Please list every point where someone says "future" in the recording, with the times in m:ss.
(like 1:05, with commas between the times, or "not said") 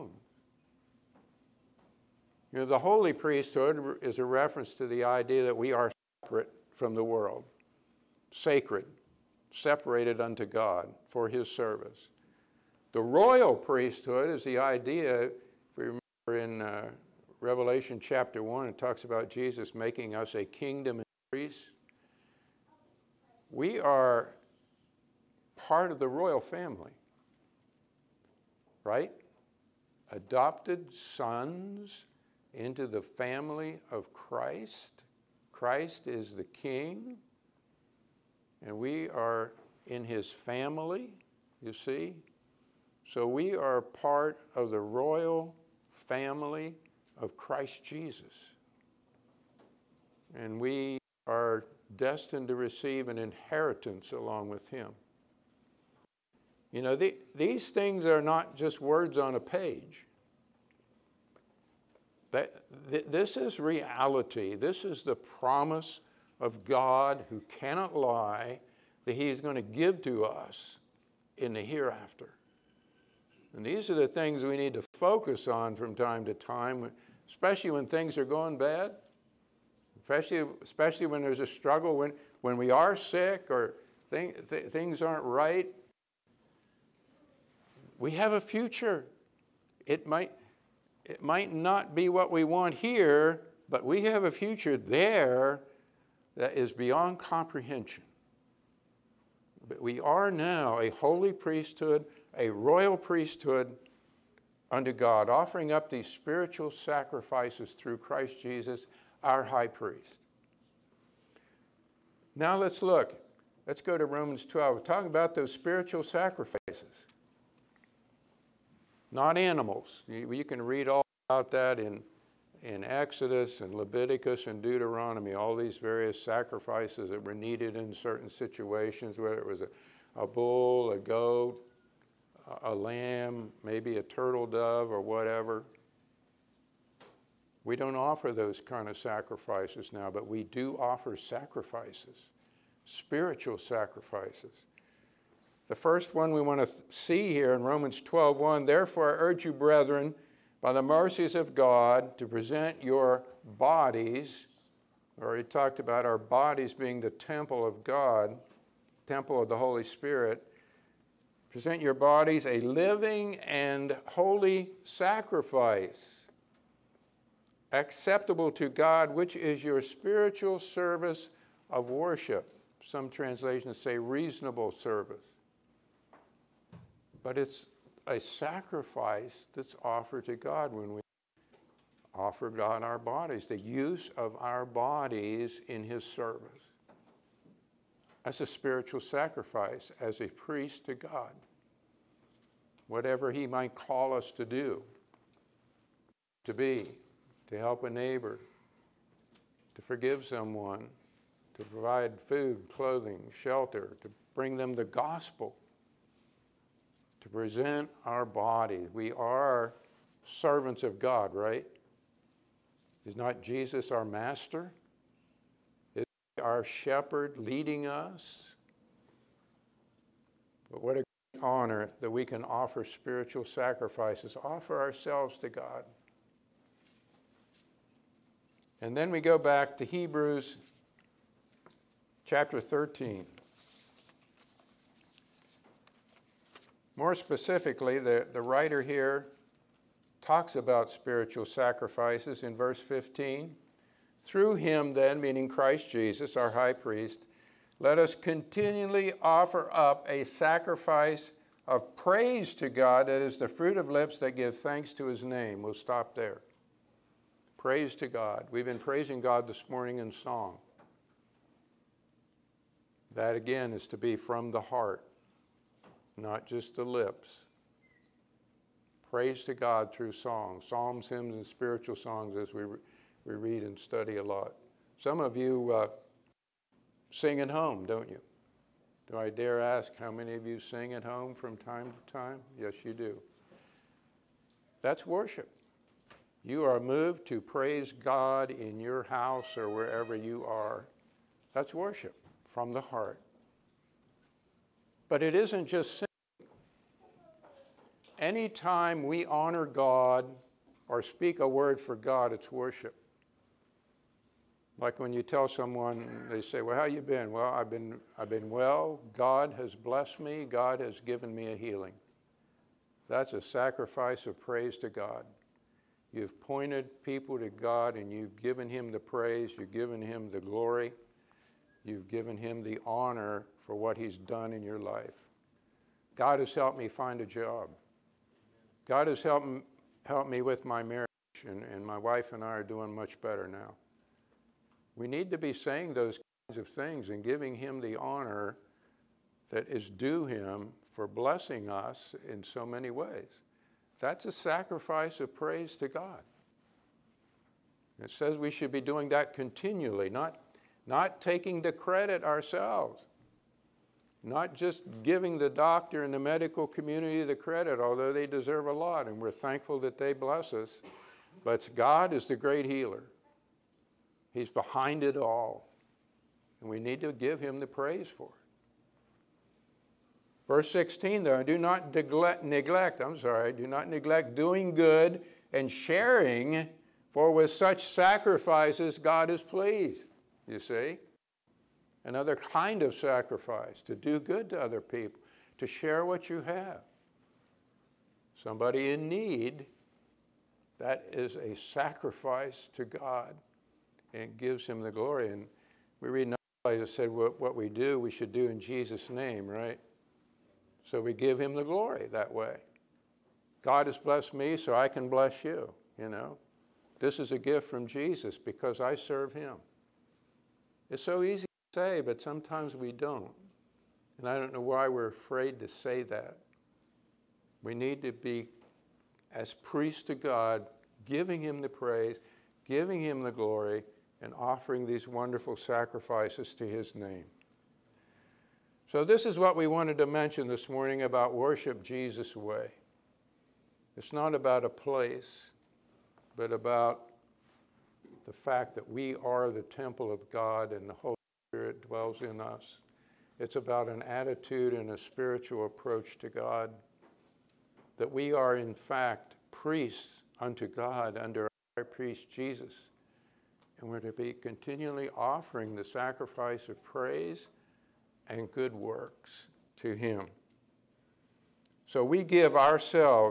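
1:28, 1:34.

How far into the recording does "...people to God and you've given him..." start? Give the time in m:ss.
5:17.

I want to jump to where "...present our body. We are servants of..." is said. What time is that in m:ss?
3:27.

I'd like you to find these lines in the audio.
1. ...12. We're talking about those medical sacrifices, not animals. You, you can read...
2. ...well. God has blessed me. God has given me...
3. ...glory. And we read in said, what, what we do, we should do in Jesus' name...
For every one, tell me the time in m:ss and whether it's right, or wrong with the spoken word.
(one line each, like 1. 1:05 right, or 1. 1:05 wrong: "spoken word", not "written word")
1. 1:54 wrong: "spiritual", not "medical"
2. 5:08 right
3. 6:34 right.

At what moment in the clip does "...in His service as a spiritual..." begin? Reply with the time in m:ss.
3:05.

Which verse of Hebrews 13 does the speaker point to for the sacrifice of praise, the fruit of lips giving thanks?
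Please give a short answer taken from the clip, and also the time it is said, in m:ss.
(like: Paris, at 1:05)
verse 15, at 4:02.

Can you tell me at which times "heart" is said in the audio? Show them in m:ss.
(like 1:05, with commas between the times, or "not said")
4:24, 4:52.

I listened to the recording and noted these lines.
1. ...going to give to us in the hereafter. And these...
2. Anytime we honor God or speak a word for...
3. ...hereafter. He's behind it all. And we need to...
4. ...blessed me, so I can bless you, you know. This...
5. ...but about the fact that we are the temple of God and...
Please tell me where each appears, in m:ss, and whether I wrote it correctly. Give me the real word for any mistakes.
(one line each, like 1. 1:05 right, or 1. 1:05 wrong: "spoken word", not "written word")
1. 1:09 right
2. 4:58 right
3. 6:02 wrong: "healer", not "hereafter"
4. 6:43 right
5. 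7:16 right.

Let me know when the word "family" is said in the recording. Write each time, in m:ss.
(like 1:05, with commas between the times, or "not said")
0:26, 0:33, 0:40, 0:45.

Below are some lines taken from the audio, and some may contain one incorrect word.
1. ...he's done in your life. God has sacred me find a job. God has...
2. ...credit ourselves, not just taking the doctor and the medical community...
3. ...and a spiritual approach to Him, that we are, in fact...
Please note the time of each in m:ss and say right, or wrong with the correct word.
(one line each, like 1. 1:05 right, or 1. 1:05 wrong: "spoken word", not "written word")
1. 5:23 wrong: "helped", not "sacred"
2. 5:51 wrong: "giving", not "taking"
3. 7:24 wrong: "God", not "Him".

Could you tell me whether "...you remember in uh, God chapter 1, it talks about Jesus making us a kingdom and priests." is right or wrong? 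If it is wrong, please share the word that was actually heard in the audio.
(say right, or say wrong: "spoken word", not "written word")
wrong: "Revelation", not "God".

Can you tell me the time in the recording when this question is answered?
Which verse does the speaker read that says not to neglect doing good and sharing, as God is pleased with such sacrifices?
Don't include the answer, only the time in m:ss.
6:10.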